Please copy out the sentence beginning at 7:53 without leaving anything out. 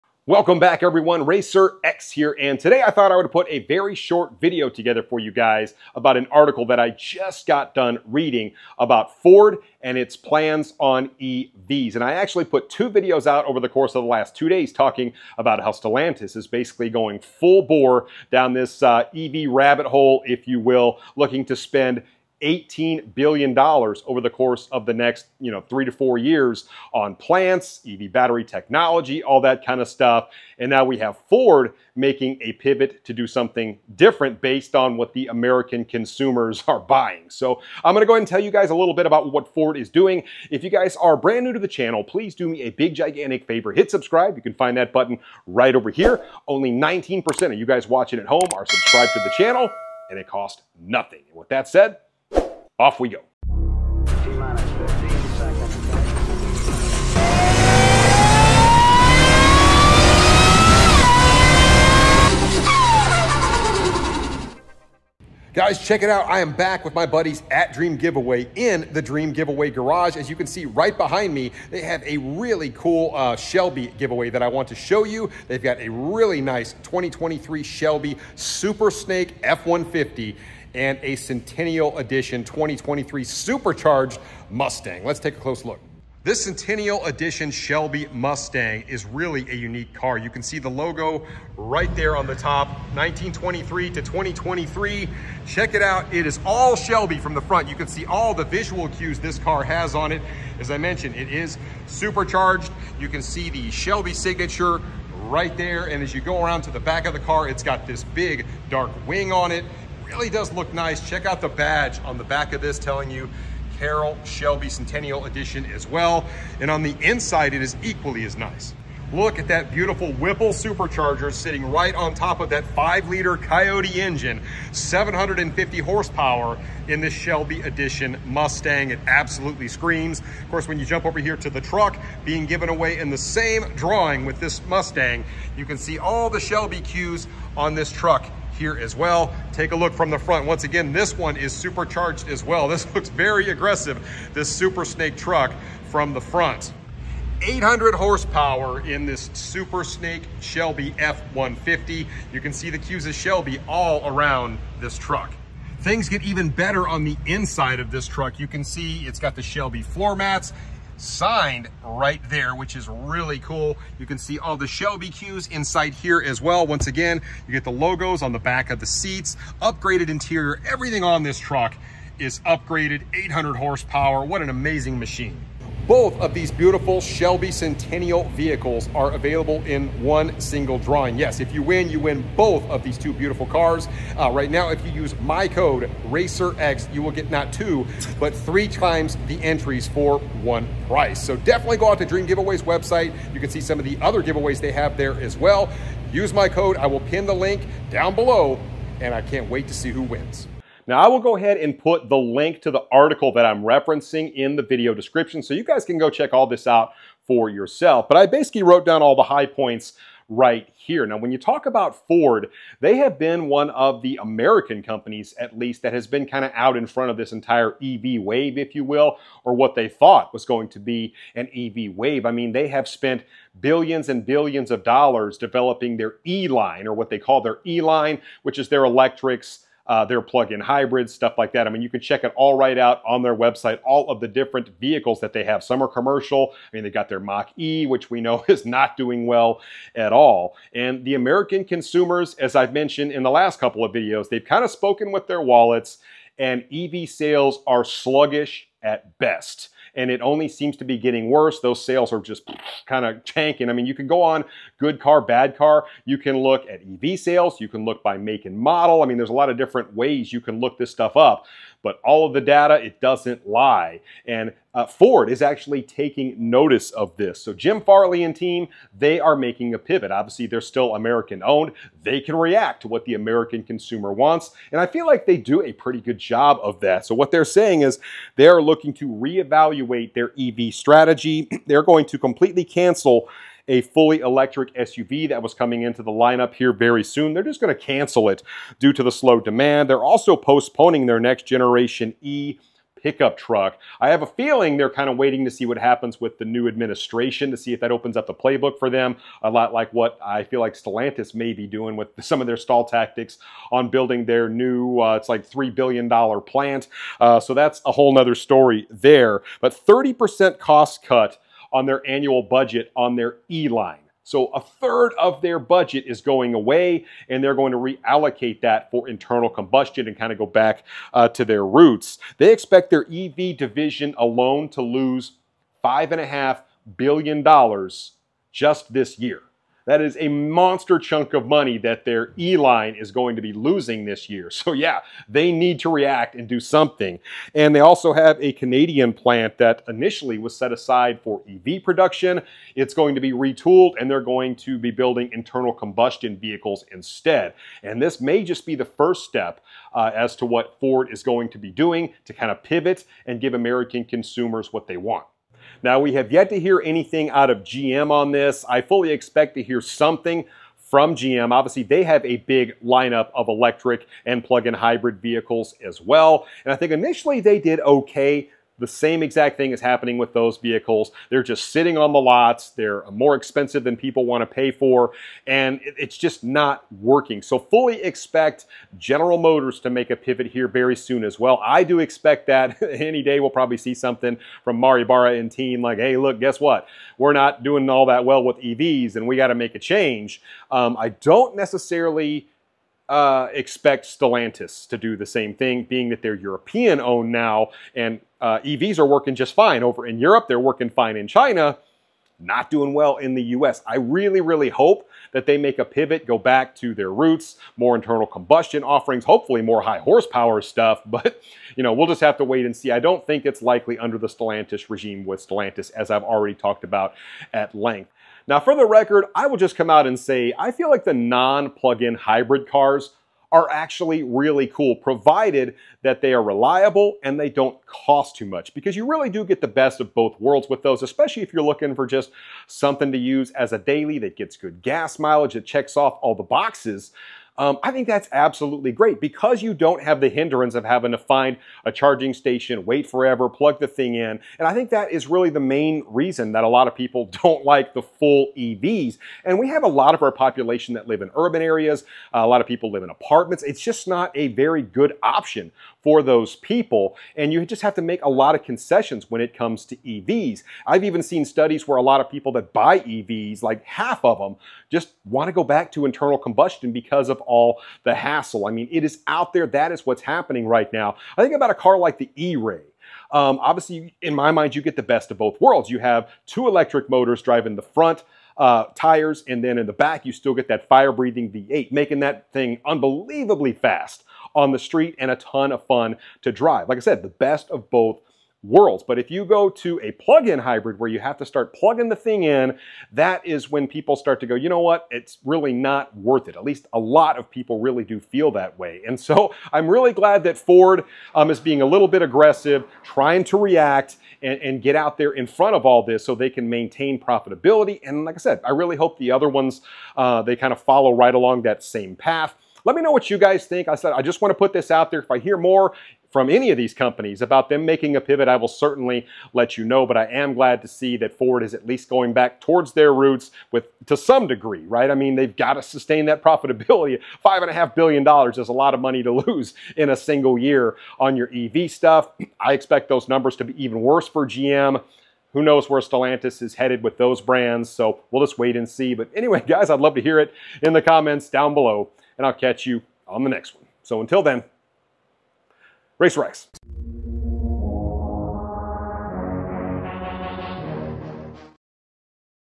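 Um, obviously, in my mind, you get the best of both worlds.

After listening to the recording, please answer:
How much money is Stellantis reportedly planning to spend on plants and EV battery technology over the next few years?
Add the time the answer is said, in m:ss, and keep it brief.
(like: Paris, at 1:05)
$18 billion, at 0:22.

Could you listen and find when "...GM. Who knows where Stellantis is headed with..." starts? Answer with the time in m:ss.
8:54.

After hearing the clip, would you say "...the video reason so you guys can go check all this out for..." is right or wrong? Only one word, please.
wrong.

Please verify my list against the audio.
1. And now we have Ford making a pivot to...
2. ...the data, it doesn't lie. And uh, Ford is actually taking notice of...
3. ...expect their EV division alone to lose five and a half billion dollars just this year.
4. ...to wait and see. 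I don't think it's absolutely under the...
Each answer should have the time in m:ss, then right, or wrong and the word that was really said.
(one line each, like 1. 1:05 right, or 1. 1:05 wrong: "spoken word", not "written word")
1. 0:30 right
2. 4:22 right
3. 5:22 right
4. 6:52 wrong: "likely", not "absolutely".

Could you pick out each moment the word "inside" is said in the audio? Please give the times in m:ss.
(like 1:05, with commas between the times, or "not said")
1:57, 2:37, 2:45.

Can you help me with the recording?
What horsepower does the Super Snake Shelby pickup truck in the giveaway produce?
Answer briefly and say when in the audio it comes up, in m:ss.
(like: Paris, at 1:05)
800, at 2:27.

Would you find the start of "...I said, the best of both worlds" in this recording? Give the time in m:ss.
8:06.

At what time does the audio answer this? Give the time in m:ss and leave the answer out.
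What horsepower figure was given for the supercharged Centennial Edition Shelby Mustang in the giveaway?
2:04.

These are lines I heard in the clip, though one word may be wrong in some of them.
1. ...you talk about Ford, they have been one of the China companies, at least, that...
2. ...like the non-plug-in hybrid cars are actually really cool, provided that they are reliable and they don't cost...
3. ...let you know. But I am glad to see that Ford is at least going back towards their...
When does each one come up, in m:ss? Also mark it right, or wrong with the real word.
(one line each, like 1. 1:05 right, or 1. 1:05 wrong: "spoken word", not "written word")
1. 3:31 wrong: "American", not "China"
2. 7:00 right
3. 8:39 right.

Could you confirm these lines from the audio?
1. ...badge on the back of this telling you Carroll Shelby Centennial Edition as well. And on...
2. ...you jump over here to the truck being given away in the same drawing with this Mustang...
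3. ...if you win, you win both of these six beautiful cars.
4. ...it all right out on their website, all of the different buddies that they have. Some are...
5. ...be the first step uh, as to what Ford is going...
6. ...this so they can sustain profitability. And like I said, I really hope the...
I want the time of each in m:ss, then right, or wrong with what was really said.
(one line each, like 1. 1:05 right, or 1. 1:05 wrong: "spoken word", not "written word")
1. 1:51 right
2. 2:10 right
3. 3:01 wrong: "two", not "six"
4. 3:52 wrong: "vehicles", not "buddies"
5. 5:48 right
6. 8:26 wrong: "maintain", not "sustain".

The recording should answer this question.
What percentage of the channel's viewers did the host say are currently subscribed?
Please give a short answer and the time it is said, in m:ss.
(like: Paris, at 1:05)
19%, at 0:46.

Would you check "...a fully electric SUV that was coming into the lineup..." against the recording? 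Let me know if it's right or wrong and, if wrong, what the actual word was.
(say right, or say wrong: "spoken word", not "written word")
right.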